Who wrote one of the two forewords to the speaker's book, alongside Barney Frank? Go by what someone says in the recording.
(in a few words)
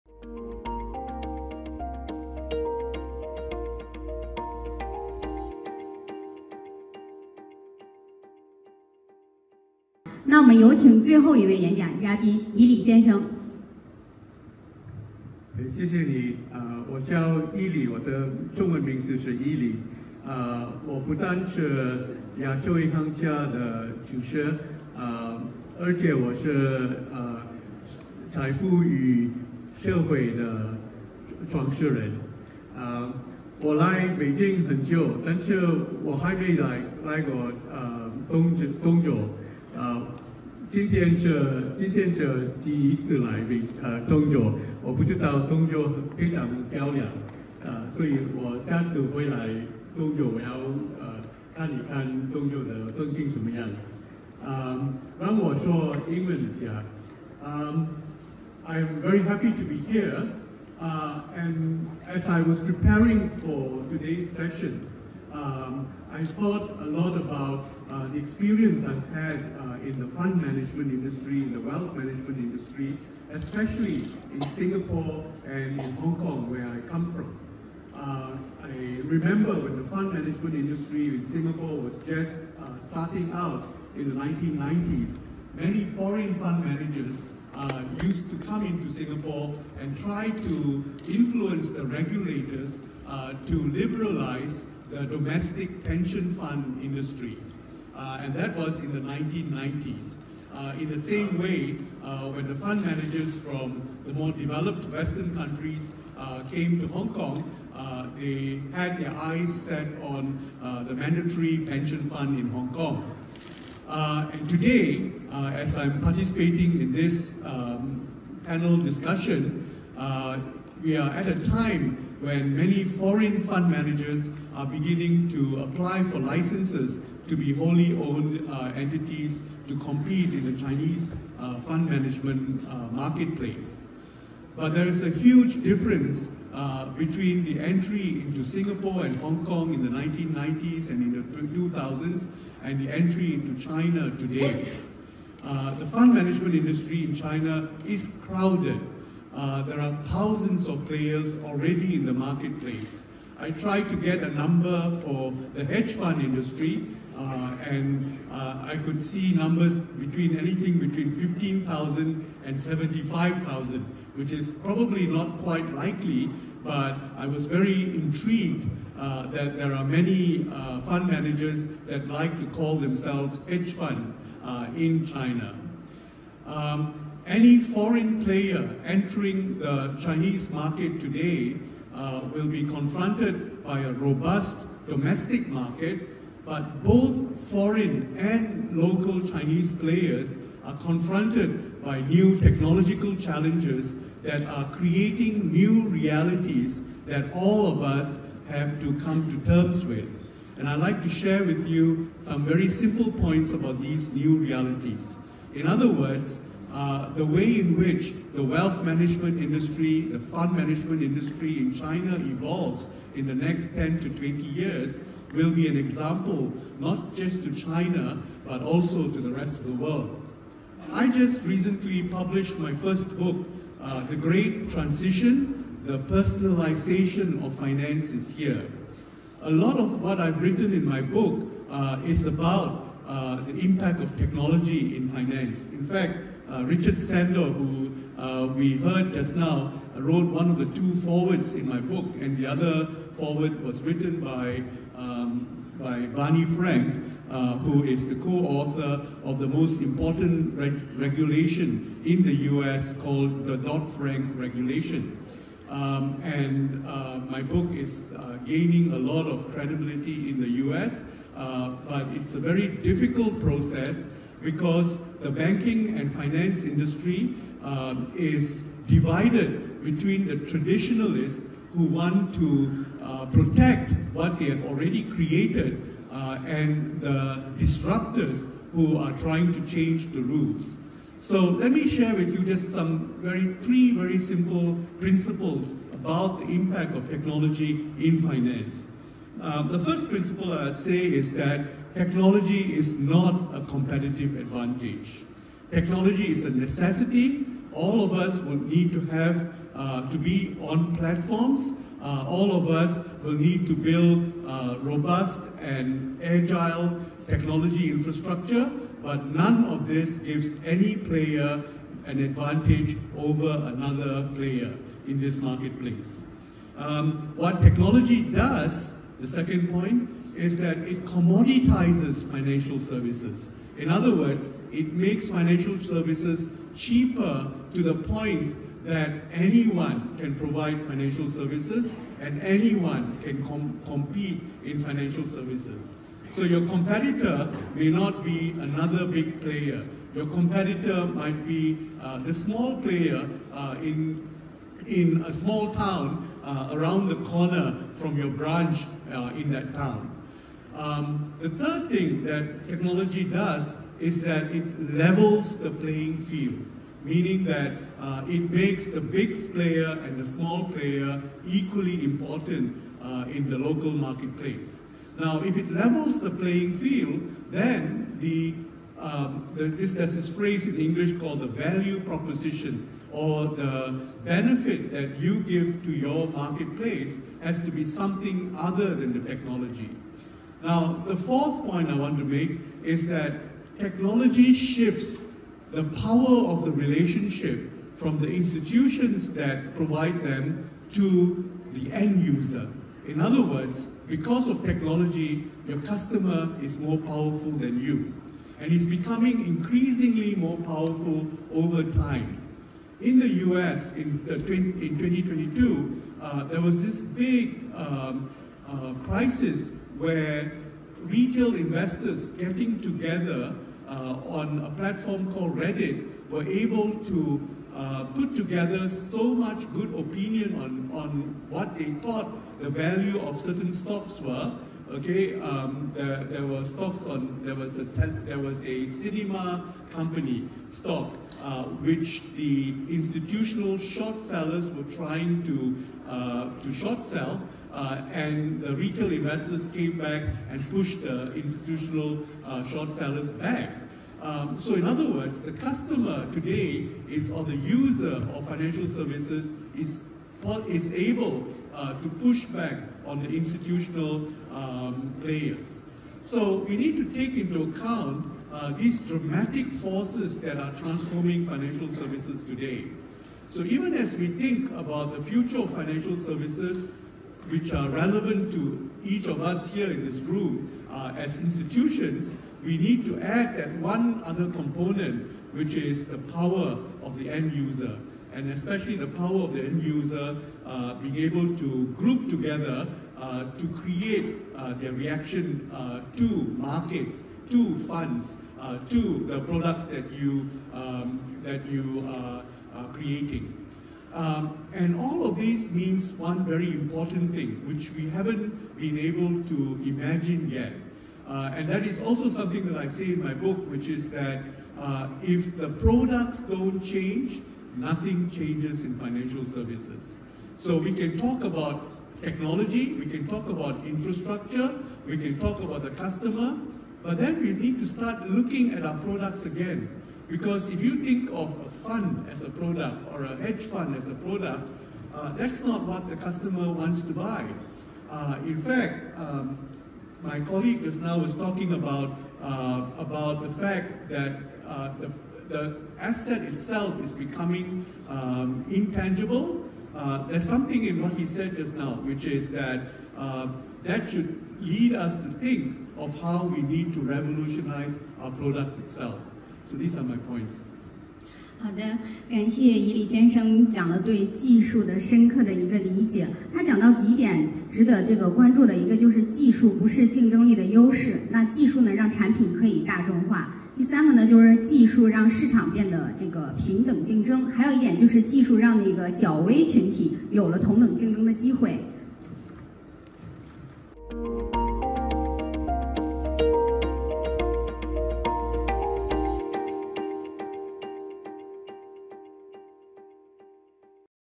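Richard Sandor.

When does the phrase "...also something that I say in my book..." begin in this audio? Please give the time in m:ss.
8:22.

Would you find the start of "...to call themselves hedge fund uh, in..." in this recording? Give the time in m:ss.
2:52.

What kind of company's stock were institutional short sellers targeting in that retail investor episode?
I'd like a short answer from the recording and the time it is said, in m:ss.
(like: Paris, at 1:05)
cinema company, at 7:08.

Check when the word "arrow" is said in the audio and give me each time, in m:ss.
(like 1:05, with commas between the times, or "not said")
not said.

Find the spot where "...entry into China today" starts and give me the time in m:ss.
2:22.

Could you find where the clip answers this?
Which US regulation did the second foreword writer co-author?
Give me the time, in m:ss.
4:13.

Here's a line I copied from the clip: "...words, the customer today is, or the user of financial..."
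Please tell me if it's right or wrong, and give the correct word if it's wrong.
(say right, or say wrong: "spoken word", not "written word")
right.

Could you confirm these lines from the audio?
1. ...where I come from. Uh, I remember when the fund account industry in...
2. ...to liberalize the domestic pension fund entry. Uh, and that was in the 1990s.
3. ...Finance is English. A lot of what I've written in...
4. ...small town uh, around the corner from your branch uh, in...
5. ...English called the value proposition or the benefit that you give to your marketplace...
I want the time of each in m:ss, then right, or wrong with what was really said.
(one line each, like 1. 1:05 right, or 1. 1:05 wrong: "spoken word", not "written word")
1. 1:16 wrong: "management", not "account"
2. 1:33 wrong: "industry", not "entry"
3. 3:47 wrong: "Here", not "English"
4. 5:45 right
5. 6:10 right.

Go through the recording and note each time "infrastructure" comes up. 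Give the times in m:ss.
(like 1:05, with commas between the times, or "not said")
5:07, 8:33.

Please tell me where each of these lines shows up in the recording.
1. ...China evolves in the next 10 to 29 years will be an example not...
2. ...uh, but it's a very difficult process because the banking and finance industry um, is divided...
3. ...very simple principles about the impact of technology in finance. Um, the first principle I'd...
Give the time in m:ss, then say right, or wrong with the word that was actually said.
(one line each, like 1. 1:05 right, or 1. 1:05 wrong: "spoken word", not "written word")
1. 3:31 wrong: "20", not "29"
2. 4:21 right
3. 4:43 right.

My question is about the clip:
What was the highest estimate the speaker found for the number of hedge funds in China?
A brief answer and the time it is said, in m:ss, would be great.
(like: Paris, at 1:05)
75,000, at 2:42.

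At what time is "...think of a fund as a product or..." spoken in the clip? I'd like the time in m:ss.
8:41.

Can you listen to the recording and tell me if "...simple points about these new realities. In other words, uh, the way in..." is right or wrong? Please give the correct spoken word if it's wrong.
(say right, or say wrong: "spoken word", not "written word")
right.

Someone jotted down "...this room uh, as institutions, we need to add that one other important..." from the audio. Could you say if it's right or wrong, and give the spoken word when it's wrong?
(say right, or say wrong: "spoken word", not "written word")
wrong: "component", not "important".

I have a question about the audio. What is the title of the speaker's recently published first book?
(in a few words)
The Great Transition.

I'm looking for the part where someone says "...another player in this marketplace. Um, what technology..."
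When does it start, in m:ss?
5:13.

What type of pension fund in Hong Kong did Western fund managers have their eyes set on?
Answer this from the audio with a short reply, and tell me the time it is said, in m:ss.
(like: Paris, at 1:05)
mandatory pension fund, at 1:50.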